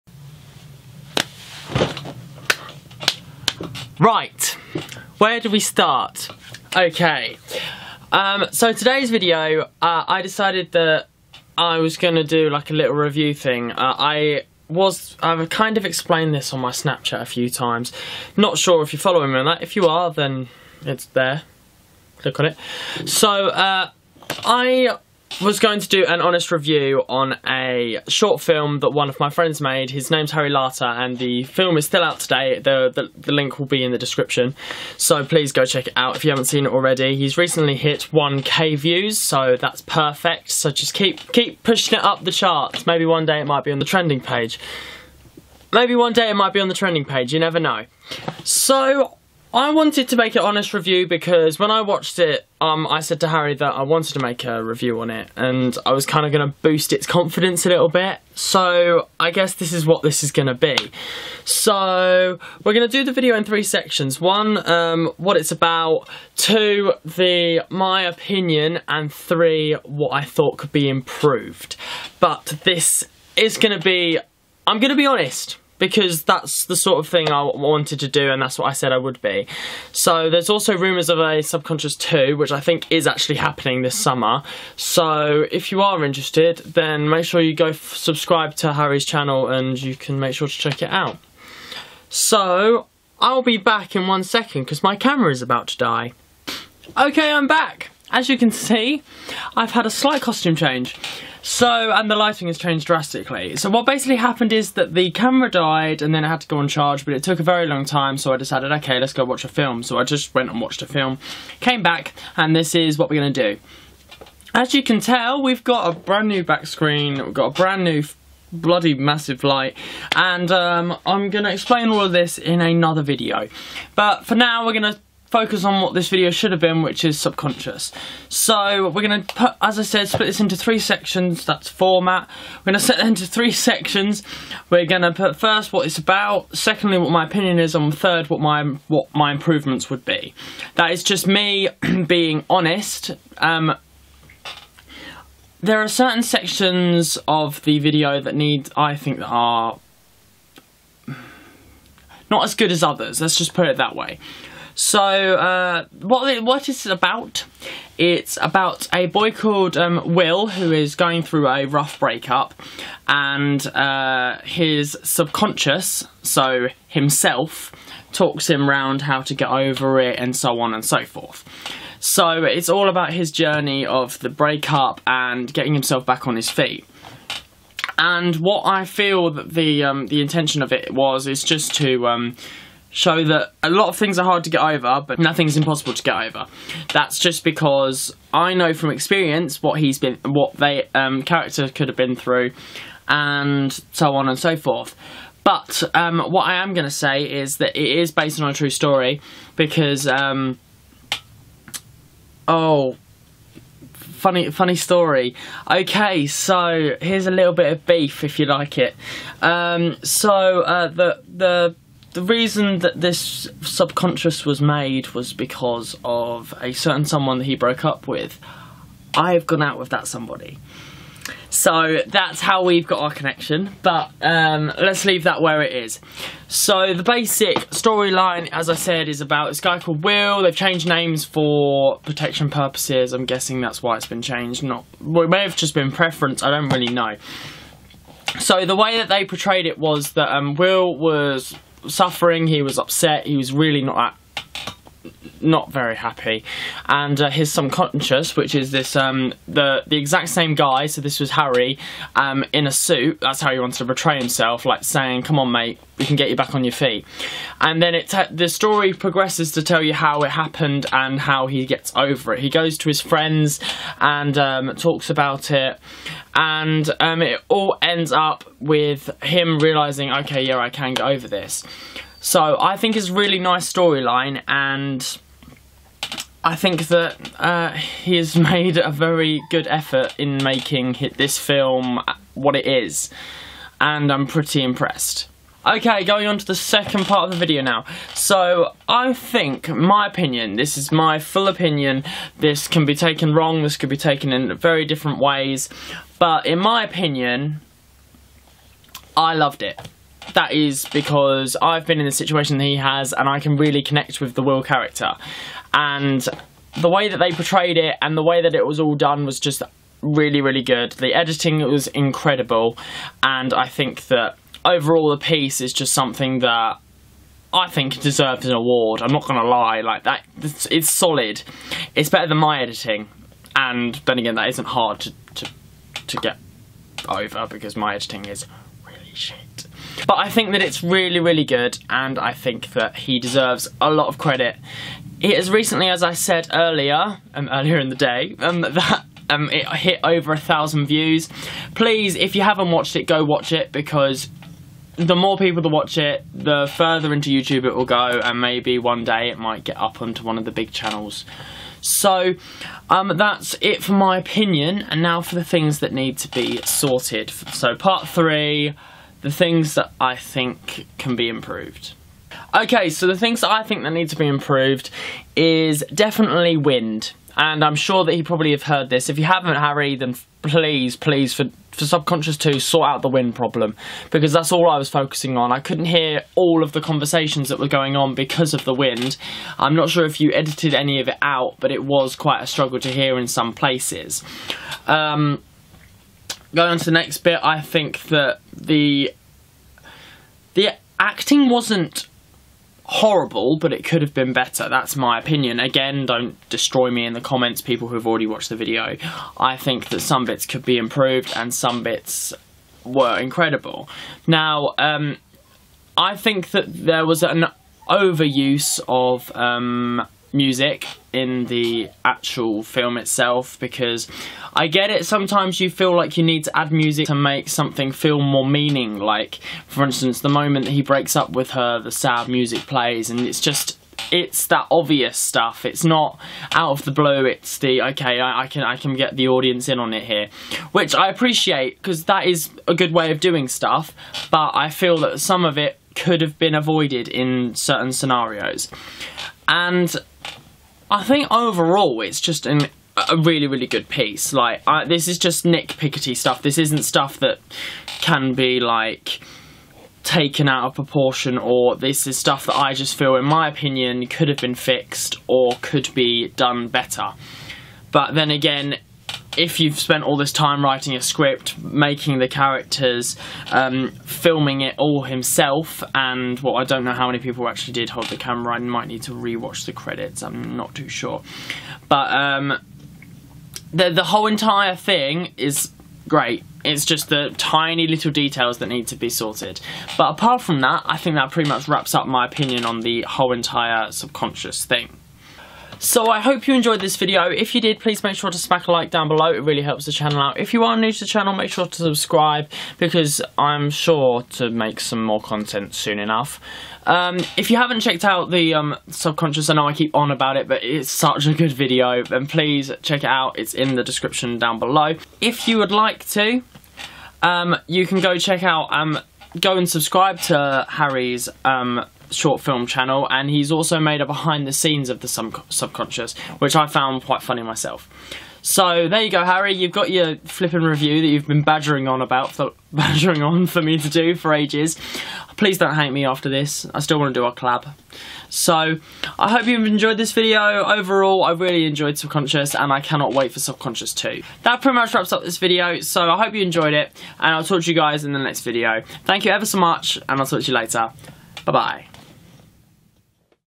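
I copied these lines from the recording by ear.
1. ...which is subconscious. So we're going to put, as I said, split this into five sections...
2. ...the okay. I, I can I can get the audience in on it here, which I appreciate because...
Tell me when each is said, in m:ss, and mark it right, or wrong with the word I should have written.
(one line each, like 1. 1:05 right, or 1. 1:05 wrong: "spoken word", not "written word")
1. 2:06 wrong: "three", not "five"
2. 7:07 right.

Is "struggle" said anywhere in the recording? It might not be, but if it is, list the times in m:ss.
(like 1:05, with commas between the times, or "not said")
6:22.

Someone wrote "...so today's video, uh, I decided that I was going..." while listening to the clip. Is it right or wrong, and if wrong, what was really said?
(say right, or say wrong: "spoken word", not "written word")
right.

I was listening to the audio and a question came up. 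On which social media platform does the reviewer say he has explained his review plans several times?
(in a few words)
Snapchat.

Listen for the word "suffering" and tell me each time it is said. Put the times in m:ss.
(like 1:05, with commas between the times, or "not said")
4:01.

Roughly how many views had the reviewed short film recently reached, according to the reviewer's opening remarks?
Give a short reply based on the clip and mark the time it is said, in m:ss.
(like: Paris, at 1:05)
1k, at 0:38.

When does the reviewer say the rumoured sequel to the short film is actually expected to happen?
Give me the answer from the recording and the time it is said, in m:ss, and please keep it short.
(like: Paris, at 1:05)
this summer, at 1:23.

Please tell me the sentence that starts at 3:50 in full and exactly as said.
They've changed names for protection purposes.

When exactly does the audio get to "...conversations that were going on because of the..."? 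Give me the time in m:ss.
6:16.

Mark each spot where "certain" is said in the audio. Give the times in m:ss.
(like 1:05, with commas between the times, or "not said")
2:25, 3:36, 7:17.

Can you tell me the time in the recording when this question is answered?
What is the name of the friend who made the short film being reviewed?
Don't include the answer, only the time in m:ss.
0:30.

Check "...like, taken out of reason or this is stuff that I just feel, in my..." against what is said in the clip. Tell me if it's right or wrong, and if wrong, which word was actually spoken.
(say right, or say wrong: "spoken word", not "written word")
wrong: "proportion", not "reason".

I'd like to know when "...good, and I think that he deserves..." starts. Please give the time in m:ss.
5:31.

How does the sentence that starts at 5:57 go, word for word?
So, part three, the things that I think can be improved.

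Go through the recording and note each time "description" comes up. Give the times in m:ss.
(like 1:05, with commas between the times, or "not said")
0:33, 8:23.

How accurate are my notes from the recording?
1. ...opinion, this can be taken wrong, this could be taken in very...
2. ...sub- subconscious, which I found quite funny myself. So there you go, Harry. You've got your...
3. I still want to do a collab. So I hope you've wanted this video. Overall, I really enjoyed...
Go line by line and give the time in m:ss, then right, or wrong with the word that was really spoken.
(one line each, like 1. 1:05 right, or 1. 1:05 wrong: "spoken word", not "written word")
1. 4:51 right
2. 8:35 right
3. 8:46 wrong: "enjoyed", not "wanted".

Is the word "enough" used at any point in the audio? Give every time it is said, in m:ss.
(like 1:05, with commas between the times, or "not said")
8:15.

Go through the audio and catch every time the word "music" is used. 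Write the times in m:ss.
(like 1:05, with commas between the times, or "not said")
6:50, 6:56, 7:02.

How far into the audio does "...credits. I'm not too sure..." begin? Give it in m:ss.
7:49.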